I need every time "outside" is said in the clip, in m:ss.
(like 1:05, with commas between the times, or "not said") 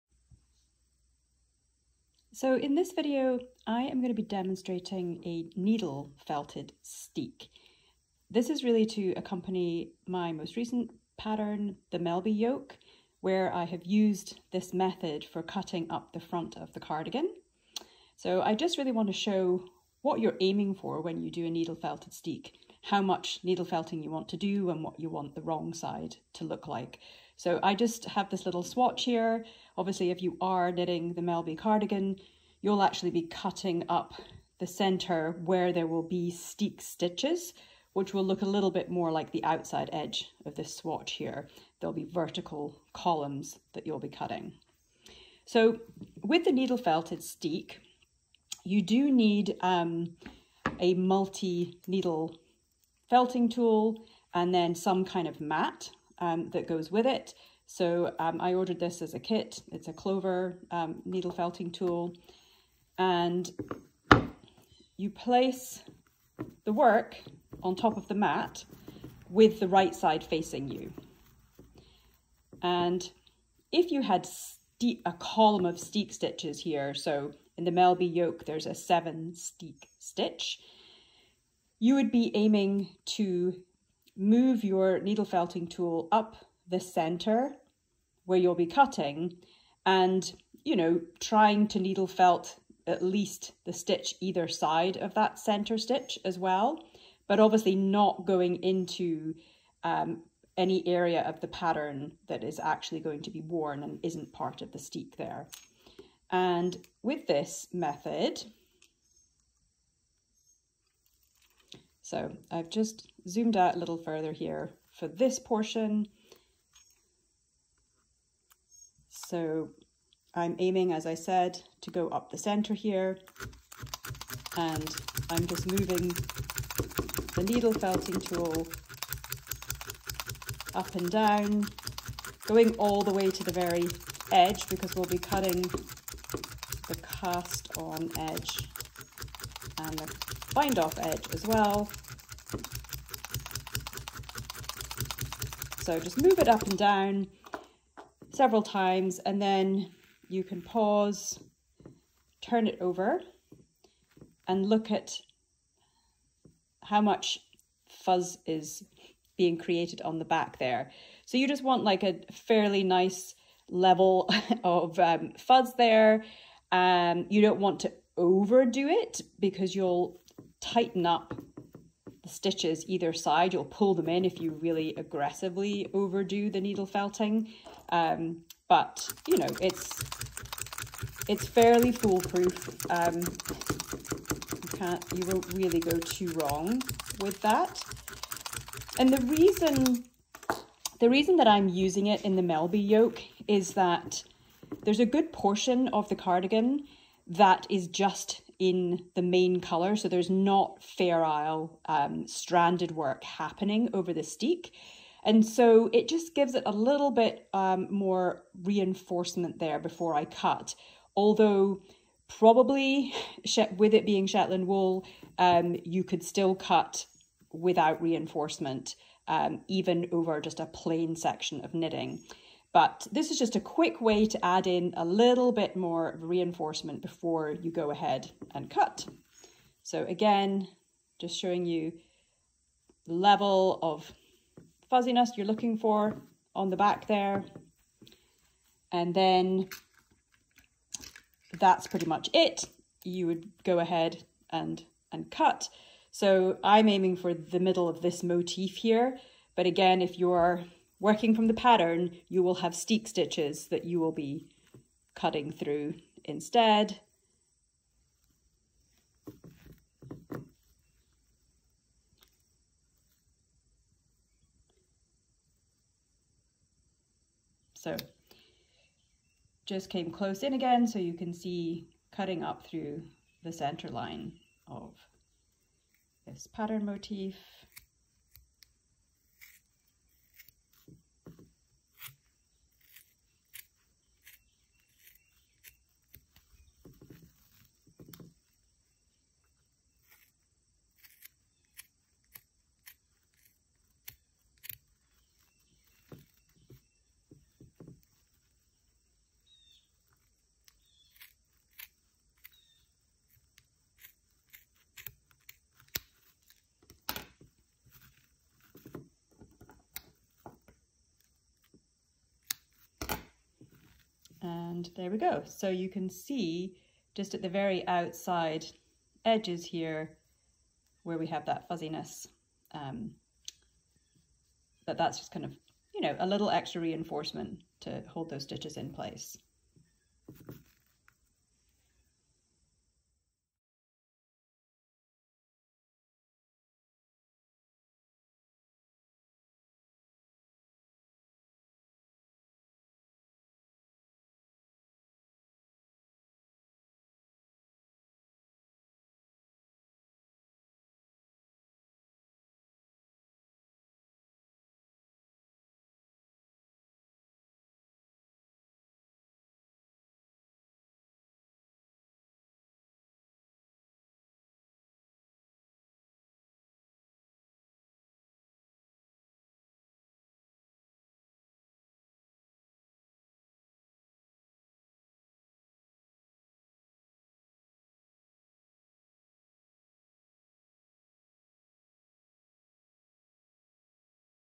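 0:39, 5:17.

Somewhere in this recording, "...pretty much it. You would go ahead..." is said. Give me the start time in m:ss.
4:01.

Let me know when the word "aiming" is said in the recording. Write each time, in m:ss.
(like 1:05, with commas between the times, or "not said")
0:20, 1:22, 2:00, 4:06.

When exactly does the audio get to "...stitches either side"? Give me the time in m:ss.
2:52.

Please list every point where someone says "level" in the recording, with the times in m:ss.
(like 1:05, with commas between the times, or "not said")
2:43, 3:53.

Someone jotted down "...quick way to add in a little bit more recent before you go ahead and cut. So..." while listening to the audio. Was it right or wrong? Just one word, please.
wrong.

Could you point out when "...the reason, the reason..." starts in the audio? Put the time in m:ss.
3:09.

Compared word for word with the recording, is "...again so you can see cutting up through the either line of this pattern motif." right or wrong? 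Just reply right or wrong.
wrong.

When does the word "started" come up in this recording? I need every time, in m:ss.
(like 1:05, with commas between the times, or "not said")
not said.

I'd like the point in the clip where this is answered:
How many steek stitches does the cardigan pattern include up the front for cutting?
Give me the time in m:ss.
1:18.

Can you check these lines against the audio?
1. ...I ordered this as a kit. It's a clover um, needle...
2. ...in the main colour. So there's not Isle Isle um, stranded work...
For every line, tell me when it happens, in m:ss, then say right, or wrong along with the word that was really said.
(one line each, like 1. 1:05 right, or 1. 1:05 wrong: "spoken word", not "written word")
1. 0:58 right
2. 3:18 wrong: "Fair", not "Isle".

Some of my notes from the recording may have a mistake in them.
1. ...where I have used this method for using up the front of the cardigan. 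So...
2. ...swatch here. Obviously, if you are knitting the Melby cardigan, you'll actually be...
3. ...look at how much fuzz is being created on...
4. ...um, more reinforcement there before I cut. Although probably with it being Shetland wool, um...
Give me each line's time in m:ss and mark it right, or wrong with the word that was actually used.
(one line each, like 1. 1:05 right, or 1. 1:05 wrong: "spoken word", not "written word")
1. 0:13 wrong: "cutting", not "using"
2. 0:28 right
3. 2:34 right
4. 3:27 right.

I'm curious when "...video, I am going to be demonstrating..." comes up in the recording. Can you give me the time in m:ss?
0:02.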